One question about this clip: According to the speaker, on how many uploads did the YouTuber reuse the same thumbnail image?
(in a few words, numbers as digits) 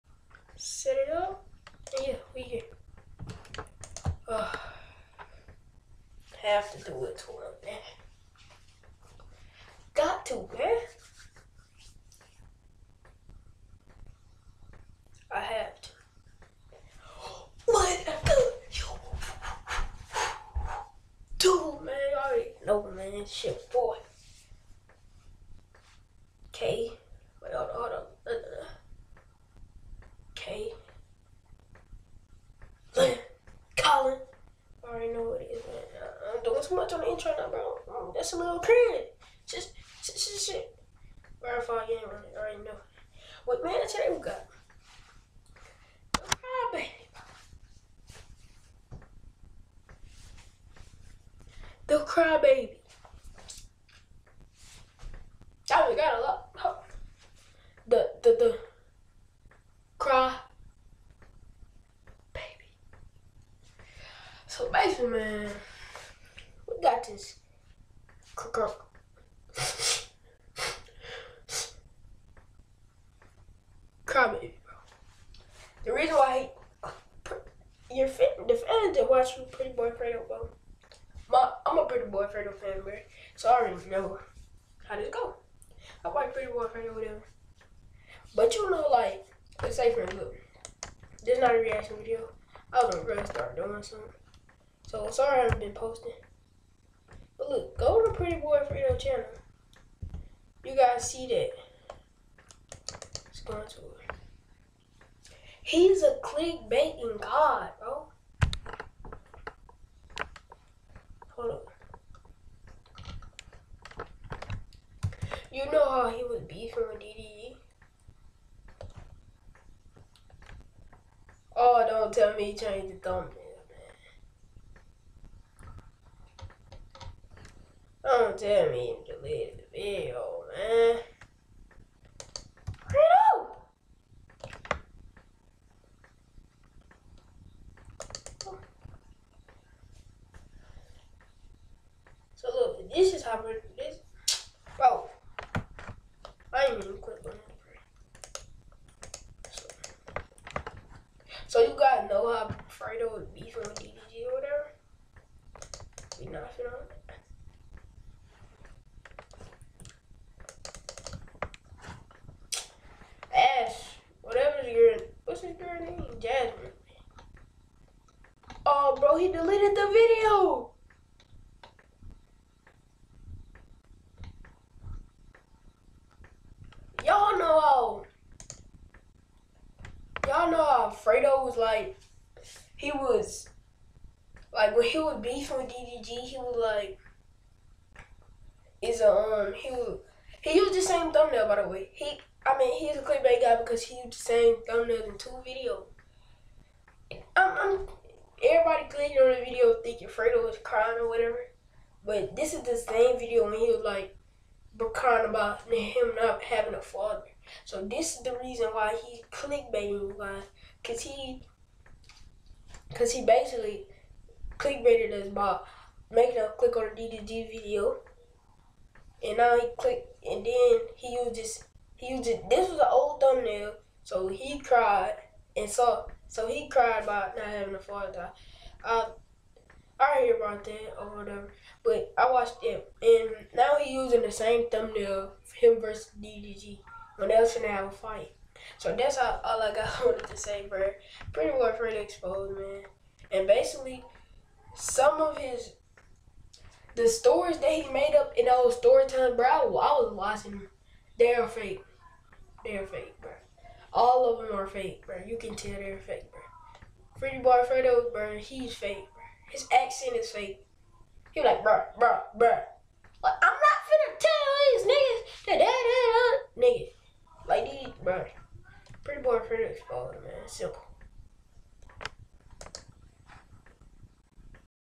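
2.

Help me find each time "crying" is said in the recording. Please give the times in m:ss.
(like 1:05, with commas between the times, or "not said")
3:20, 3:24.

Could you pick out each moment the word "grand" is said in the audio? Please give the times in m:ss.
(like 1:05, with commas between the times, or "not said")
not said.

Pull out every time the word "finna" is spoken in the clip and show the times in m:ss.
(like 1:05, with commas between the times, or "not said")
2:36, 4:23.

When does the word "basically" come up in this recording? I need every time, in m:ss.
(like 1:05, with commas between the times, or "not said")
1:04, 3:33, 4:03.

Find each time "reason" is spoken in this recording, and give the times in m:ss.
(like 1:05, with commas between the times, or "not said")
1:15, 3:28.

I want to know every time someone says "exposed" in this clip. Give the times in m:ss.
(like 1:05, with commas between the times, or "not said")
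4:01, 4:29.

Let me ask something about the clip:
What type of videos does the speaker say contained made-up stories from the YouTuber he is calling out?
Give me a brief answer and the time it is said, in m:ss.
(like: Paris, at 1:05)
storytelling, at 4:08.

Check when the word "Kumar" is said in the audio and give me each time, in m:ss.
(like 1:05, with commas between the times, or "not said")
not said.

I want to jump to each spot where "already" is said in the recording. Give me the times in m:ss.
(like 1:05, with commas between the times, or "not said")
0:42, 1:23.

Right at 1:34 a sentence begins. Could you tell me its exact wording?
So sorry I haven't been posting.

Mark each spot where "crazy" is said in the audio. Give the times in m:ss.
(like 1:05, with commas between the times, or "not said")
0:38.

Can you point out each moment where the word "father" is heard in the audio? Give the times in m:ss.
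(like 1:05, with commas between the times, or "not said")
3:26, 3:47.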